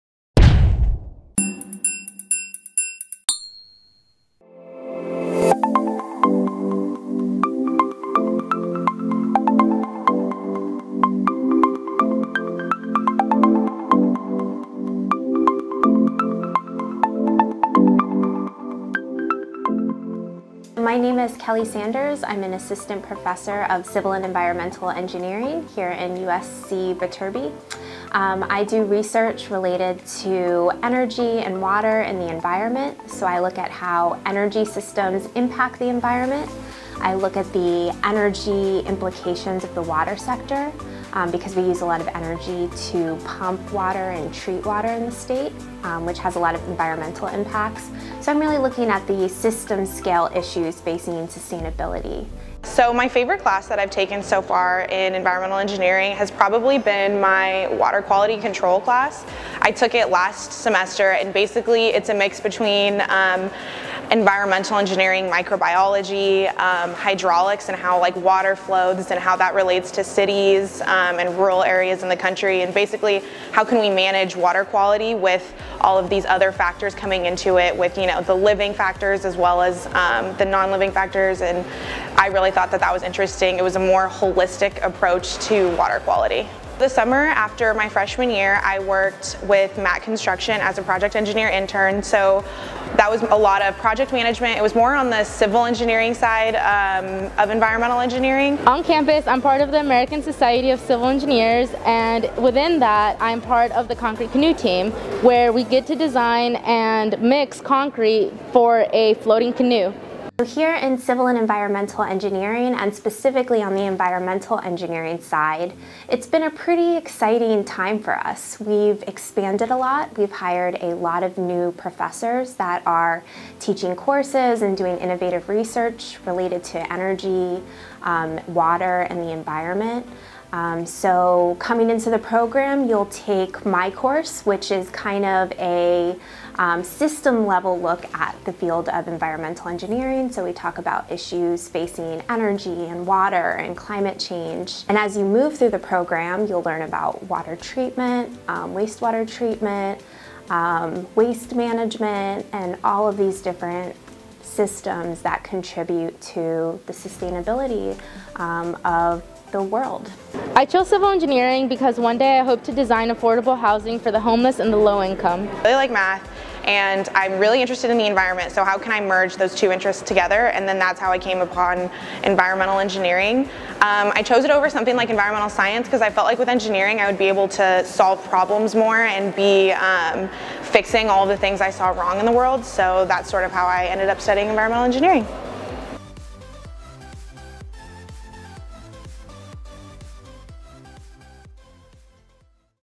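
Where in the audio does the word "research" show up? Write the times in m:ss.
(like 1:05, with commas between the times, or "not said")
0:28, 2:05.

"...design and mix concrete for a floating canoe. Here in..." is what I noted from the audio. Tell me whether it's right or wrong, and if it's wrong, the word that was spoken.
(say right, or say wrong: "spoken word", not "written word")
right.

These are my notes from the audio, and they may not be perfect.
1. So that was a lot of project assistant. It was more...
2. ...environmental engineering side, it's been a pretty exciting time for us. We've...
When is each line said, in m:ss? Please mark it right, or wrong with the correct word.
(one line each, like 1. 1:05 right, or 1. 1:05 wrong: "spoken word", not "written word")
1. 1:32 wrong: "management", not "assistant"
2. 1:53 right.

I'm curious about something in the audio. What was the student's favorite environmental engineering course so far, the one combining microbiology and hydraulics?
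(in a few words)
Water quality control.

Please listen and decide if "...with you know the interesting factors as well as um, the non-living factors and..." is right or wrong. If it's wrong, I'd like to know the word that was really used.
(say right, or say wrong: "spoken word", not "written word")
wrong: "living", not "interesting".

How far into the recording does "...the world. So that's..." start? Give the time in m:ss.
3:02.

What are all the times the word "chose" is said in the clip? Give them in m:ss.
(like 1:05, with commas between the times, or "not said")
2:40, 2:54.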